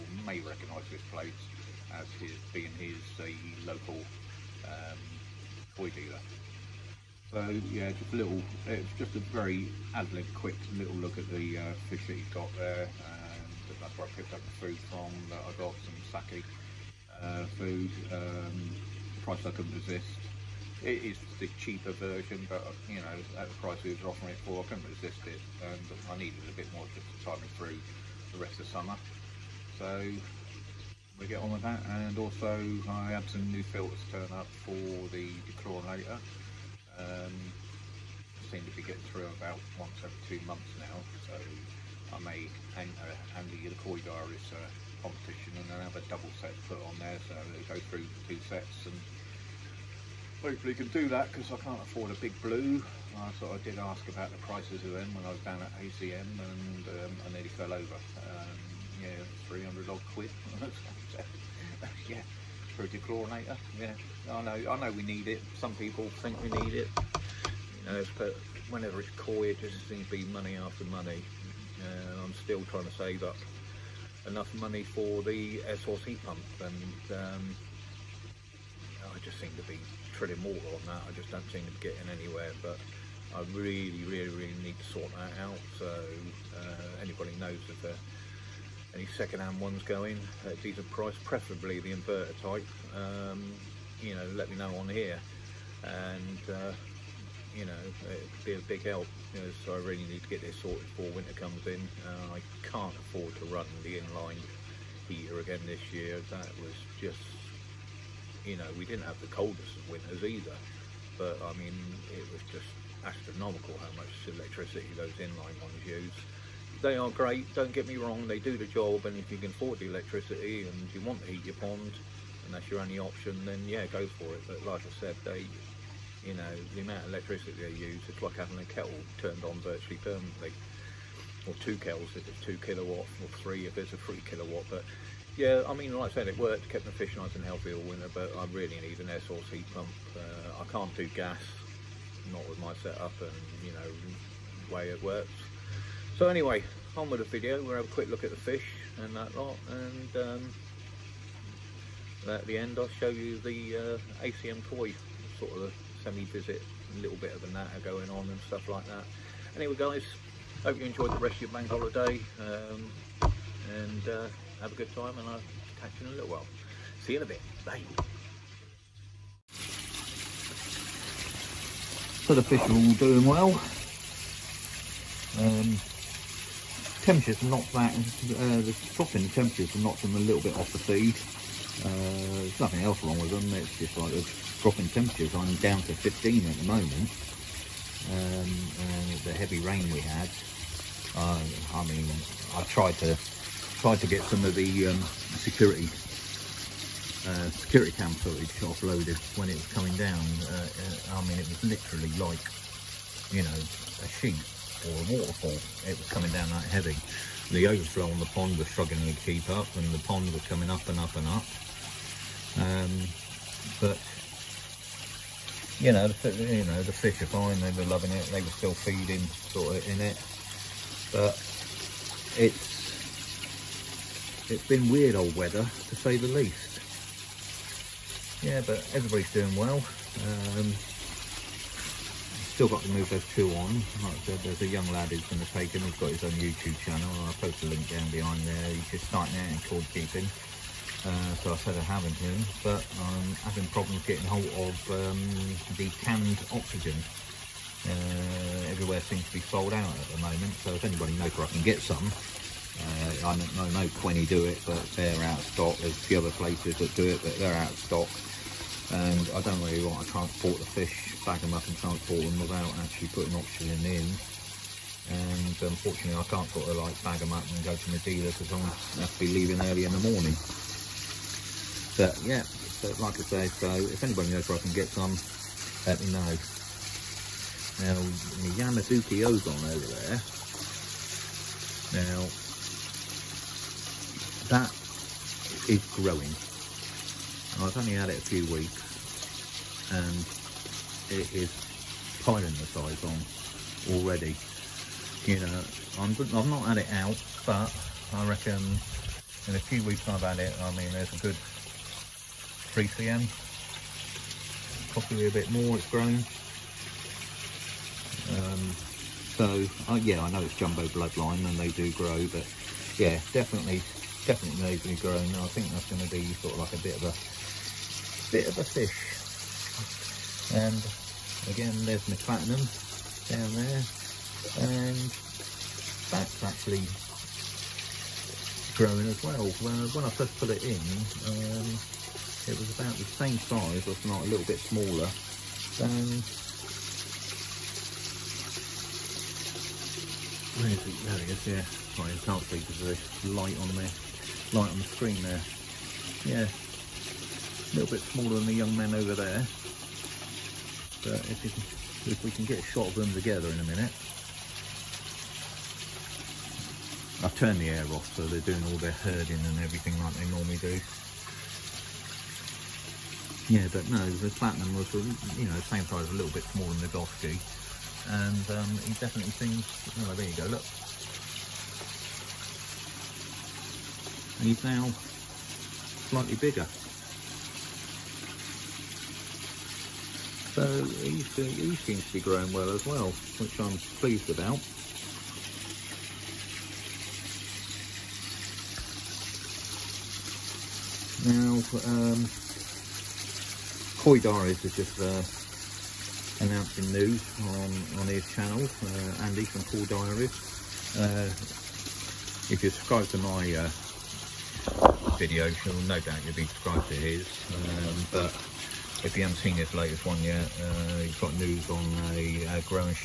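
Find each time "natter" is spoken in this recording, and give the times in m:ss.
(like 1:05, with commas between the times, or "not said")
2:37.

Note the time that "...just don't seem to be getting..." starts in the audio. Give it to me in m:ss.
1:21.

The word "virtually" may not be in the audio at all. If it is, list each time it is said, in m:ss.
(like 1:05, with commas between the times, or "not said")
2:09.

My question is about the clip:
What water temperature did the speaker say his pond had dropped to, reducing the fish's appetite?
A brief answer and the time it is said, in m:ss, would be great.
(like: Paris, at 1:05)
15, at 3:05.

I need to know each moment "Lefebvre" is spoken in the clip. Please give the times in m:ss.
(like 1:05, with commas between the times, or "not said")
not said.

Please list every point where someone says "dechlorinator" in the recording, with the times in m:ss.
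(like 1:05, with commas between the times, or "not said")
0:35, 1:02.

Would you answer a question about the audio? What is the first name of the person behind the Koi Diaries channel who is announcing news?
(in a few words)
Andy.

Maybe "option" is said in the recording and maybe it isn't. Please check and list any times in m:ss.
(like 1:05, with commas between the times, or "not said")
2:02.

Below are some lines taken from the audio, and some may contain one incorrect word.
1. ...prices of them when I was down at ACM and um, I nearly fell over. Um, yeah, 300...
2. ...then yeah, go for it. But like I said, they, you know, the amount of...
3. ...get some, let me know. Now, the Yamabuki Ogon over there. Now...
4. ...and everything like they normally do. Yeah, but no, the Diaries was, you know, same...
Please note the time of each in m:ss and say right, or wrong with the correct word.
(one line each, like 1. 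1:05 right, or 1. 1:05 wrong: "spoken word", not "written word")
1. 0:54 right
2. 2:03 right
3. 4:34 right
4. 5:59 wrong: "Platinum", not "Diaries".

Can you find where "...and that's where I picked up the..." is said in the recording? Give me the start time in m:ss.
0:12.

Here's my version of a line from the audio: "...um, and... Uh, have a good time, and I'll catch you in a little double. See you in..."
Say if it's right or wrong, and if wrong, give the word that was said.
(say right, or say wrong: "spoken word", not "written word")
wrong: "while", not "double".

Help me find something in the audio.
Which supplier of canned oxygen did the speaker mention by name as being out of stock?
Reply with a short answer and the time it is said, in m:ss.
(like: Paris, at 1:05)
Quenny, at 4:14.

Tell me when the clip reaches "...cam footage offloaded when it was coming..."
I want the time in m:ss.
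3:17.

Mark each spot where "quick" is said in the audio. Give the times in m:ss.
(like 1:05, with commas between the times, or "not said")
0:10, 2:27.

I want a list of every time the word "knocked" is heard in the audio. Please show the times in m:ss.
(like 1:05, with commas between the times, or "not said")
2:59.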